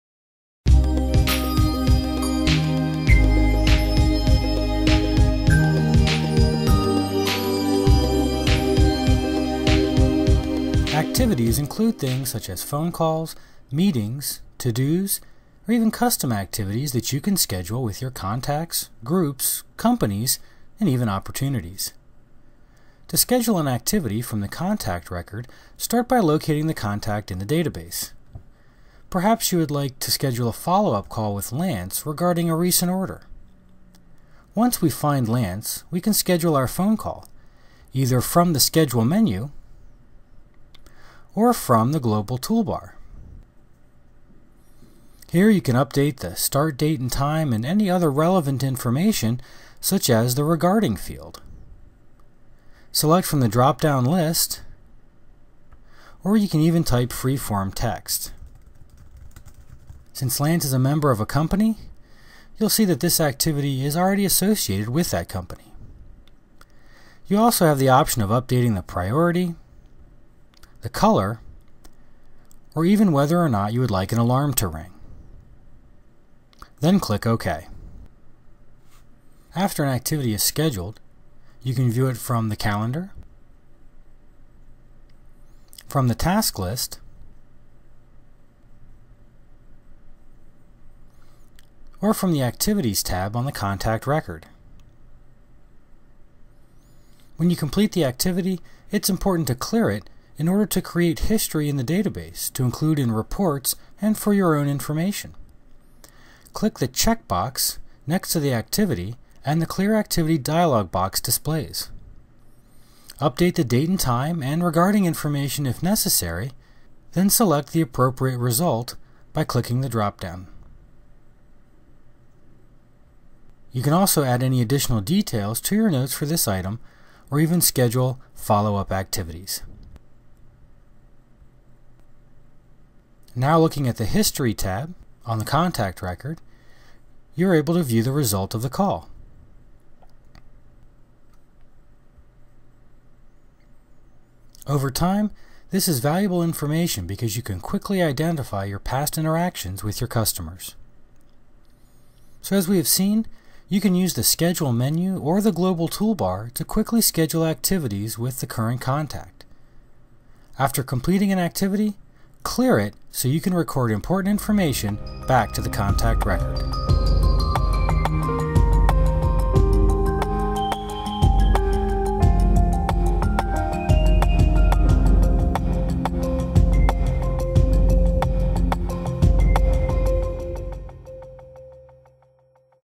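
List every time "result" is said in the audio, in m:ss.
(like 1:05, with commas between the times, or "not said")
1:58, 2:18.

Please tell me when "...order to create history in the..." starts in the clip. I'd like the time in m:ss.
1:40.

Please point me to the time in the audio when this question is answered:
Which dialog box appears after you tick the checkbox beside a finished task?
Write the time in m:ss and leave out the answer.
1:49.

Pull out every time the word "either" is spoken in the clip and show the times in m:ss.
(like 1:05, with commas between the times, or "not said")
0:37.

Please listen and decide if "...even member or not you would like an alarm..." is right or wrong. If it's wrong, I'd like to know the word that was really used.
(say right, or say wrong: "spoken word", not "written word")
wrong: "whether", not "member".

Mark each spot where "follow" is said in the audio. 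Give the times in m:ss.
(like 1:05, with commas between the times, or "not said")
0:30, 2:08.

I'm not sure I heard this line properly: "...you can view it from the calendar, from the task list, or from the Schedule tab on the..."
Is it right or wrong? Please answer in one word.
wrong.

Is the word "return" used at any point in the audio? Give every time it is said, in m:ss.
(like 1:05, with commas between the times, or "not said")
not said.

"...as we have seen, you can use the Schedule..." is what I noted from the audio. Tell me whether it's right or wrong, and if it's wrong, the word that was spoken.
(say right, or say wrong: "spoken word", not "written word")
right.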